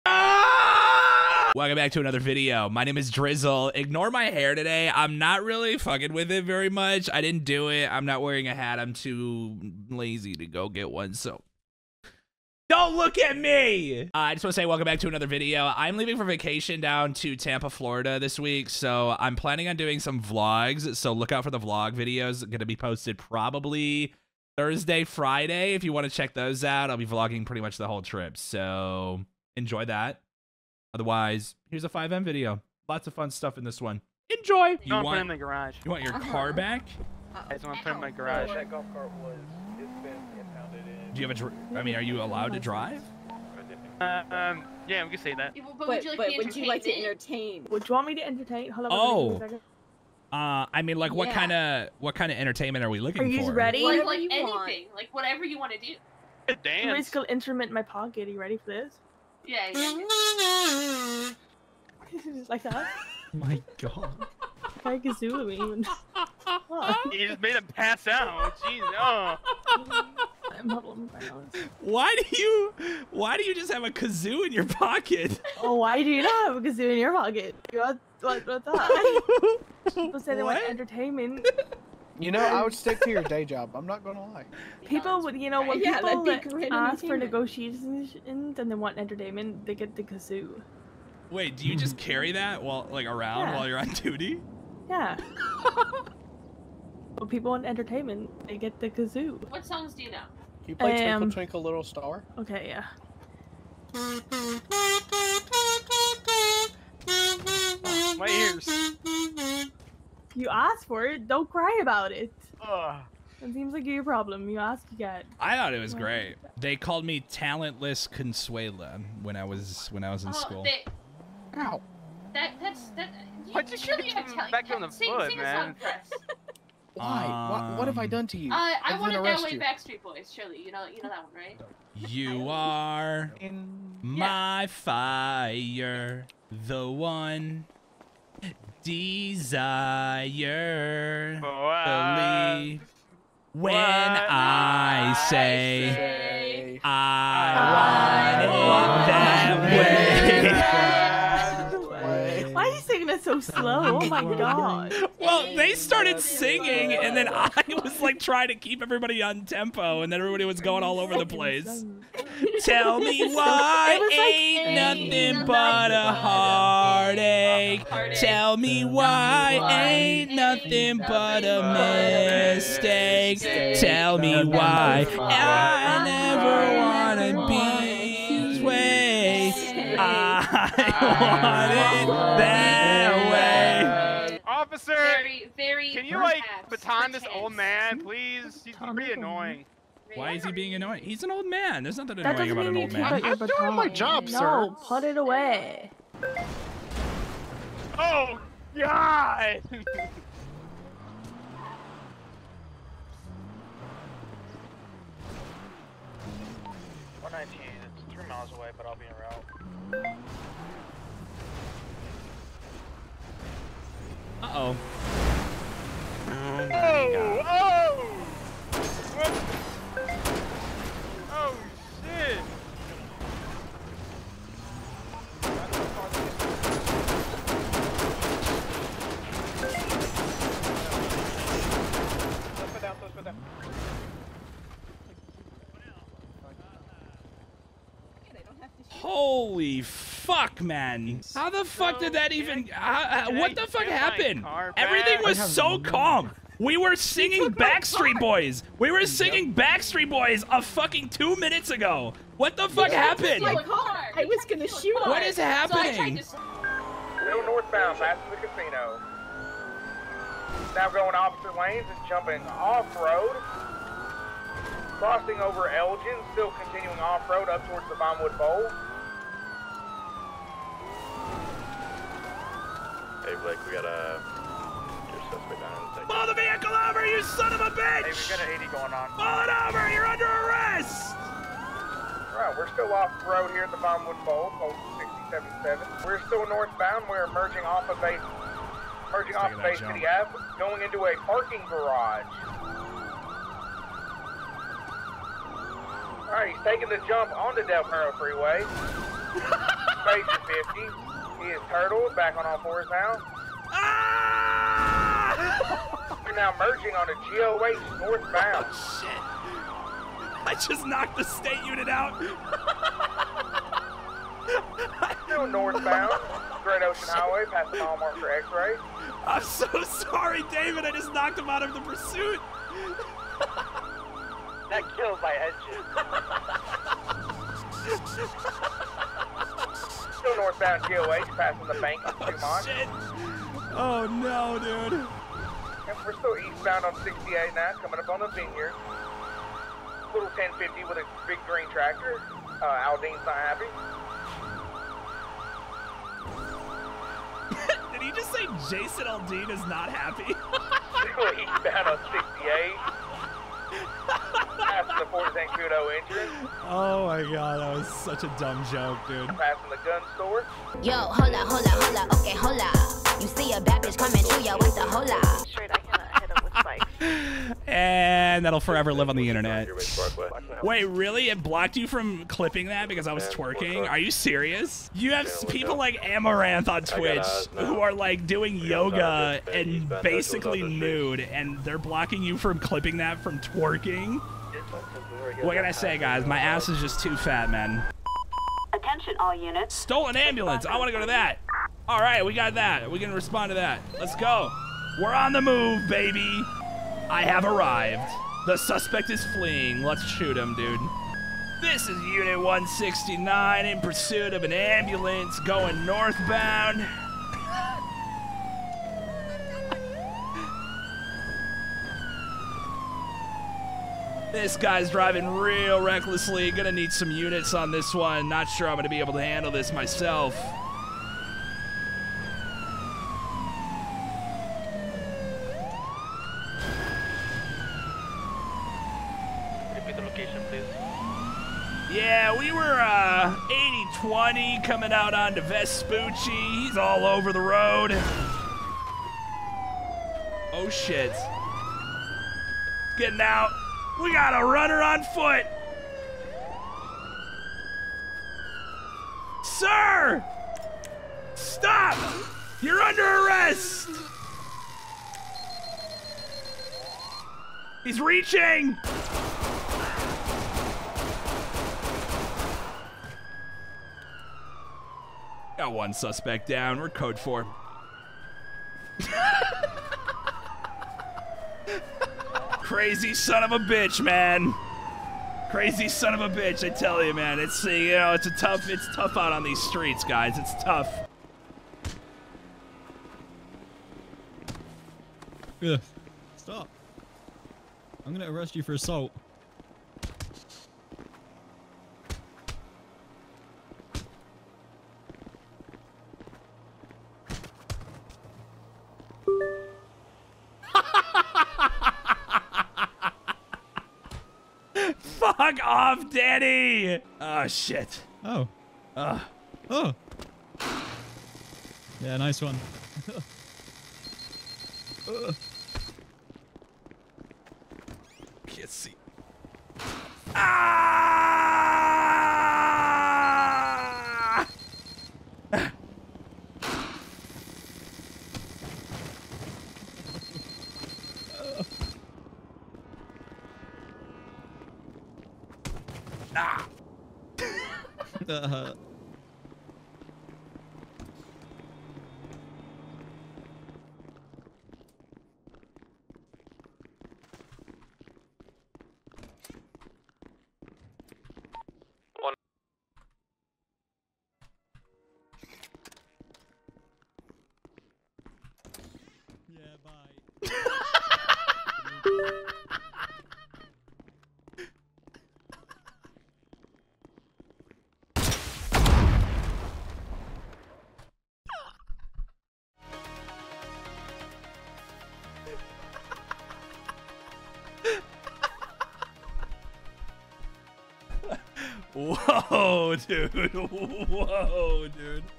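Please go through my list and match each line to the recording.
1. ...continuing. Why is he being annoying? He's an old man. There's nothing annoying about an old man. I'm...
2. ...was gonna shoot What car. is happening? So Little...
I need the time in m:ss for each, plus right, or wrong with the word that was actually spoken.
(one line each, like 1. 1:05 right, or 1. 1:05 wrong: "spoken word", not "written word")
1. 3:09 wrong: "annoying", not "continuing"
2. 4:14 right.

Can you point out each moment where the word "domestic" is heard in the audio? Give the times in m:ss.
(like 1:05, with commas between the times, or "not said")
not said.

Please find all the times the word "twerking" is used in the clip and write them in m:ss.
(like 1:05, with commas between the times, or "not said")
6:13, 6:23.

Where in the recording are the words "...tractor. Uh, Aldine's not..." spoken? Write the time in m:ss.
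5:41.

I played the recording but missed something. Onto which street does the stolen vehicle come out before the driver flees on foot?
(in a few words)
Vespucci.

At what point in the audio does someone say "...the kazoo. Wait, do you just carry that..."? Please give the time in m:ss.
1:29.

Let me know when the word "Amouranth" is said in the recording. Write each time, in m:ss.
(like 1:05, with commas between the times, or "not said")
6:16.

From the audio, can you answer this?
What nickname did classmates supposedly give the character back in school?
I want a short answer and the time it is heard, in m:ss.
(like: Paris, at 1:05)
Talentless Consuela, at 1:57.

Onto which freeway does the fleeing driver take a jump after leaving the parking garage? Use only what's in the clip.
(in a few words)
Del Perro Freeway.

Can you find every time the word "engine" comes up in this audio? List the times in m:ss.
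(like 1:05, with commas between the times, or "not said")
5:25.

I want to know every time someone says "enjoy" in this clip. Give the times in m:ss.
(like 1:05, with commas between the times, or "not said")
0:29, 0:34.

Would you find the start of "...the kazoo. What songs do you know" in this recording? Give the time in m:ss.
1:38.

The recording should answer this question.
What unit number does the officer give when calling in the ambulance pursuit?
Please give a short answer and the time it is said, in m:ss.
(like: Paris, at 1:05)
169, at 6:42.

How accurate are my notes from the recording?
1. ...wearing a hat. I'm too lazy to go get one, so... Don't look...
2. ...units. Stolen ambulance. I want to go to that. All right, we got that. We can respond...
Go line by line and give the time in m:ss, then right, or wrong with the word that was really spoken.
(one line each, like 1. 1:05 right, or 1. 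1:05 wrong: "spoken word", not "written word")
1. 0:08 right
2. 6:29 right.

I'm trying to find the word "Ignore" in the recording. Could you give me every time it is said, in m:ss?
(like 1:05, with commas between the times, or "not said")
0:03.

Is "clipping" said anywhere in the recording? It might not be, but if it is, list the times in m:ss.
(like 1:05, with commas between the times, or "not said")
6:12, 6:22.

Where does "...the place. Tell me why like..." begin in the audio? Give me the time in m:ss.
2:41.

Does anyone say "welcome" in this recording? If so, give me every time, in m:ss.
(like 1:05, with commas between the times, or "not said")
0:01, 0:14.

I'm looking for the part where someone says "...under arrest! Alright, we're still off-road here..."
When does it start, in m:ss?
4:40.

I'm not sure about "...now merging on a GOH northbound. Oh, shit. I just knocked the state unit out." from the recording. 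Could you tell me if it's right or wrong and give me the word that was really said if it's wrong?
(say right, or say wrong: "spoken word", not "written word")
right.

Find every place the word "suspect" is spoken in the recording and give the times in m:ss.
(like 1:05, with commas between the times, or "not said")
4:35, 6:38, 7:45.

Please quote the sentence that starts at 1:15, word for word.
Oh, why do you not have a kazoo in your pocket?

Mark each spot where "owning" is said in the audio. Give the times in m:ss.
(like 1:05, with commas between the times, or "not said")
not said.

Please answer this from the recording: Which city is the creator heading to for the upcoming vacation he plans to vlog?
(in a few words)
Tampa, Florida.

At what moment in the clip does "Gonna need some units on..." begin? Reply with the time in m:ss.
6:56.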